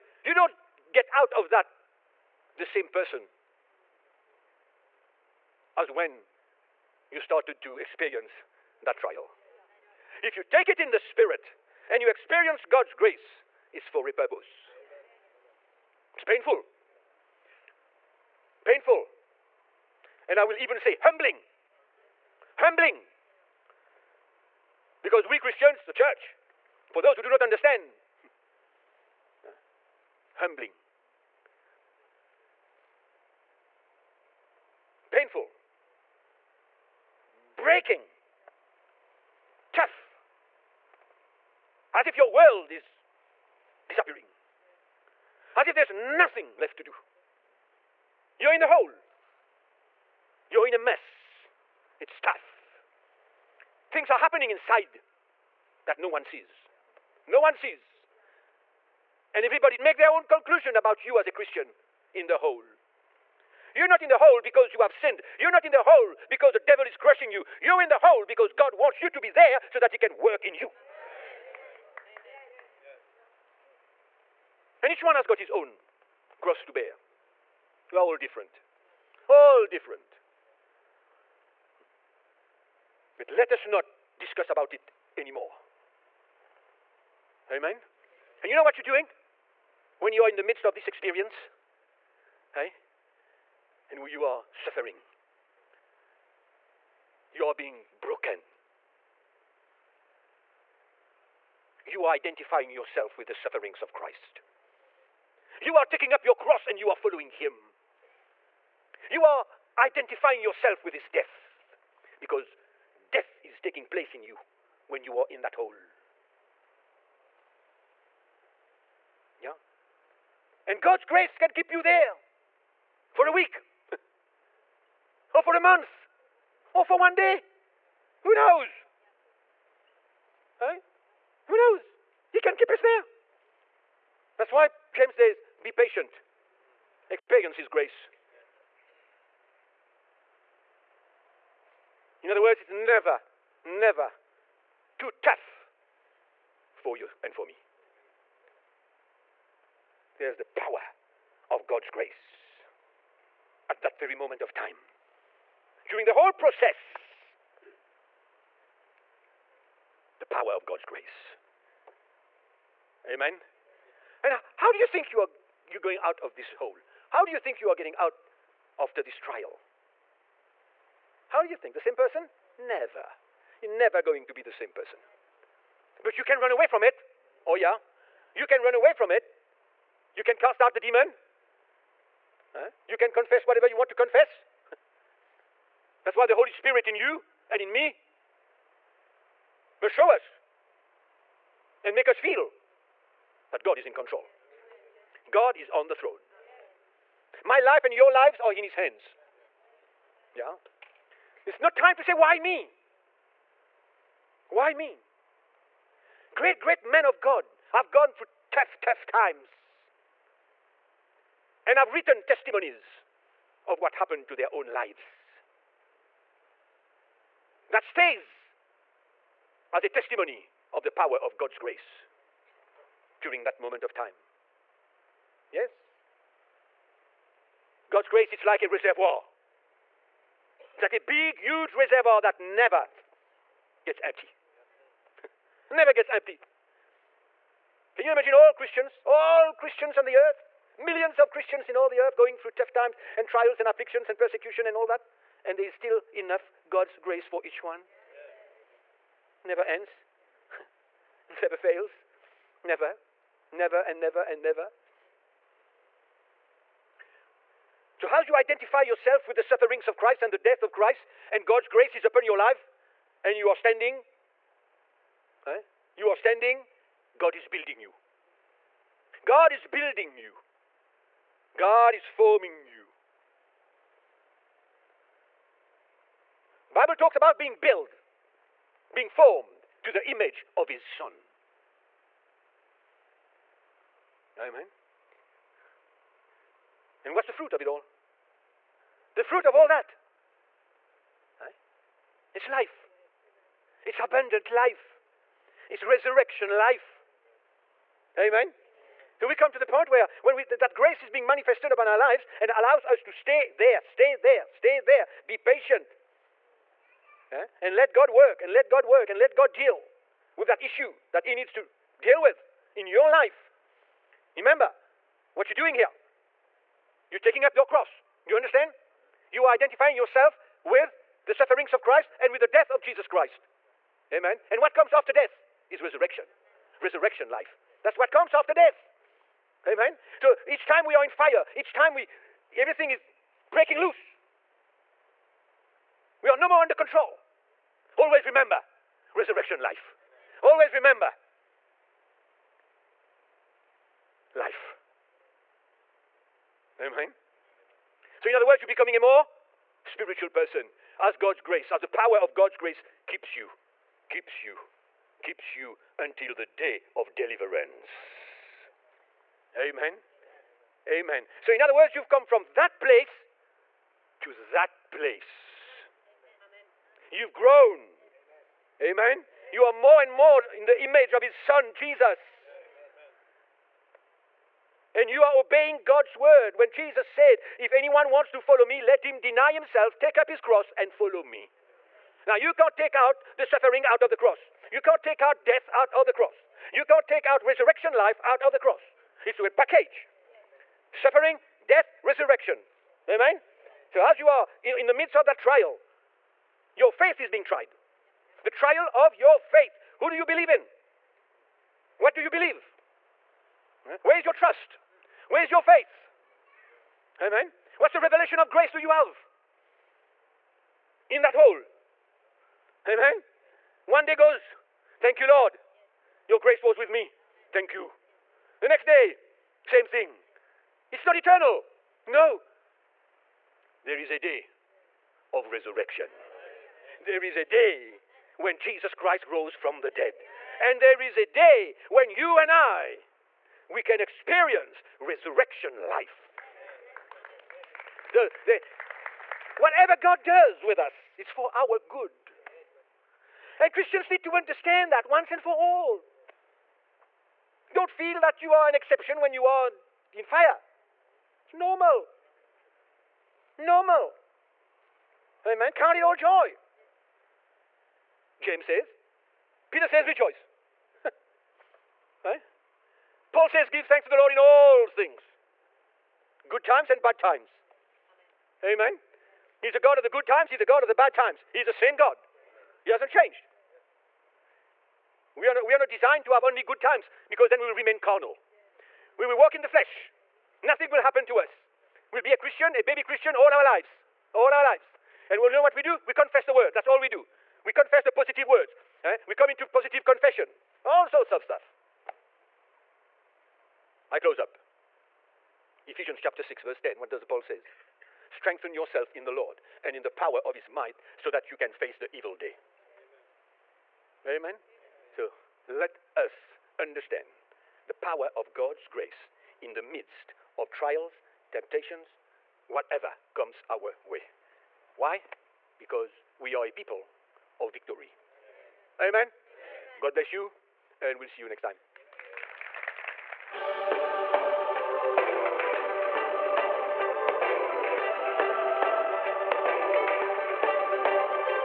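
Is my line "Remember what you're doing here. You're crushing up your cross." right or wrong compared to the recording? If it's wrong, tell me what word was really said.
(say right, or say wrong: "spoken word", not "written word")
wrong: "taking", not "crushing".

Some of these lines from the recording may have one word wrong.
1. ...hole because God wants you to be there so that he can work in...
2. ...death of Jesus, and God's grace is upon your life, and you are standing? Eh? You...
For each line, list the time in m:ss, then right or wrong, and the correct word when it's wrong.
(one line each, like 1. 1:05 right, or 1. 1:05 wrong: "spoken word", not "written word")
1. 1:07 right
2. 4:20 wrong: "Christ", not "Jesus".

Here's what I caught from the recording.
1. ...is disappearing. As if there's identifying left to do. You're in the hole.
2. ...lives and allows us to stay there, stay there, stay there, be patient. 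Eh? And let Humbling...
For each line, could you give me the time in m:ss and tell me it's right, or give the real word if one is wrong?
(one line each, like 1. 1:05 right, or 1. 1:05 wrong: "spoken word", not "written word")
1. 0:42 wrong: "nothing", not "identifying"
2. 5:01 wrong: "God", not "Humbling".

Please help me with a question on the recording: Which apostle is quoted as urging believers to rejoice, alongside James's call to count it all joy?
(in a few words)
Peter.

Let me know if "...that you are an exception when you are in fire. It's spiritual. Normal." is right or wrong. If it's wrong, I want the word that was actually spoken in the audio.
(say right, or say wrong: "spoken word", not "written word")
wrong: "normal", not "spiritual".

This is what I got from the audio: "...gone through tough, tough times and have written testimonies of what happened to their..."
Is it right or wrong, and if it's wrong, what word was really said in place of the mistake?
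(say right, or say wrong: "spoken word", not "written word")
right.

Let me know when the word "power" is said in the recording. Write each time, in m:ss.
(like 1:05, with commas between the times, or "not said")
2:30, 2:40, 3:40, 5:51, 8:20, 8:27.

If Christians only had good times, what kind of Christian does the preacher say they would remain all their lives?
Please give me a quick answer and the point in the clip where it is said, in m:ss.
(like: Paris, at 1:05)
A baby Christian, at 8:02.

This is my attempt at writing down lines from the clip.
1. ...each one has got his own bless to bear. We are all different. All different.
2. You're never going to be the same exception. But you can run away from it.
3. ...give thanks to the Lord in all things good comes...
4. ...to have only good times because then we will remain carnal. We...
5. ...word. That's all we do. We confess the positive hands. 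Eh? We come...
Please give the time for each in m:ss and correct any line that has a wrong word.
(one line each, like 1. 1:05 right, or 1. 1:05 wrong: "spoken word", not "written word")
1. 1:14 wrong: "cross", not "bless"
2. 2:53 wrong: "person", not "exception"
3. 7:43 wrong: "times", not "comes"
4. 7:56 right
5. 8:06 wrong: "words", not "hands".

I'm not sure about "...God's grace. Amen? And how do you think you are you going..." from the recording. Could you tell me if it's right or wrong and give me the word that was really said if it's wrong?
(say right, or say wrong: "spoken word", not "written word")
right.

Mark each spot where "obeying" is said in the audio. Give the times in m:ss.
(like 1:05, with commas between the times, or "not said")
6:15.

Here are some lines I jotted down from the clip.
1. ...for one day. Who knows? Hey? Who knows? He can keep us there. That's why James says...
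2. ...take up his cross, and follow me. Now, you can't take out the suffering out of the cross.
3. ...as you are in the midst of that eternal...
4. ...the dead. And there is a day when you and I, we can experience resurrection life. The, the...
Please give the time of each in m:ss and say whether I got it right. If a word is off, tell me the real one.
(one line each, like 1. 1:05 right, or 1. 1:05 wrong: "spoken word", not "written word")
1. 2:06 right
2. 6:19 right
3. 6:33 wrong: "trial", not "eternal"
4. 7:09 right.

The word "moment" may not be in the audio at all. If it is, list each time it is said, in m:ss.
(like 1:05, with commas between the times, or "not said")
2:34, 3:43.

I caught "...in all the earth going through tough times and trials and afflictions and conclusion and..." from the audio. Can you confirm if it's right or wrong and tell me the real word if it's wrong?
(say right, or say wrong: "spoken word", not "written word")
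wrong: "persecution", not "conclusion".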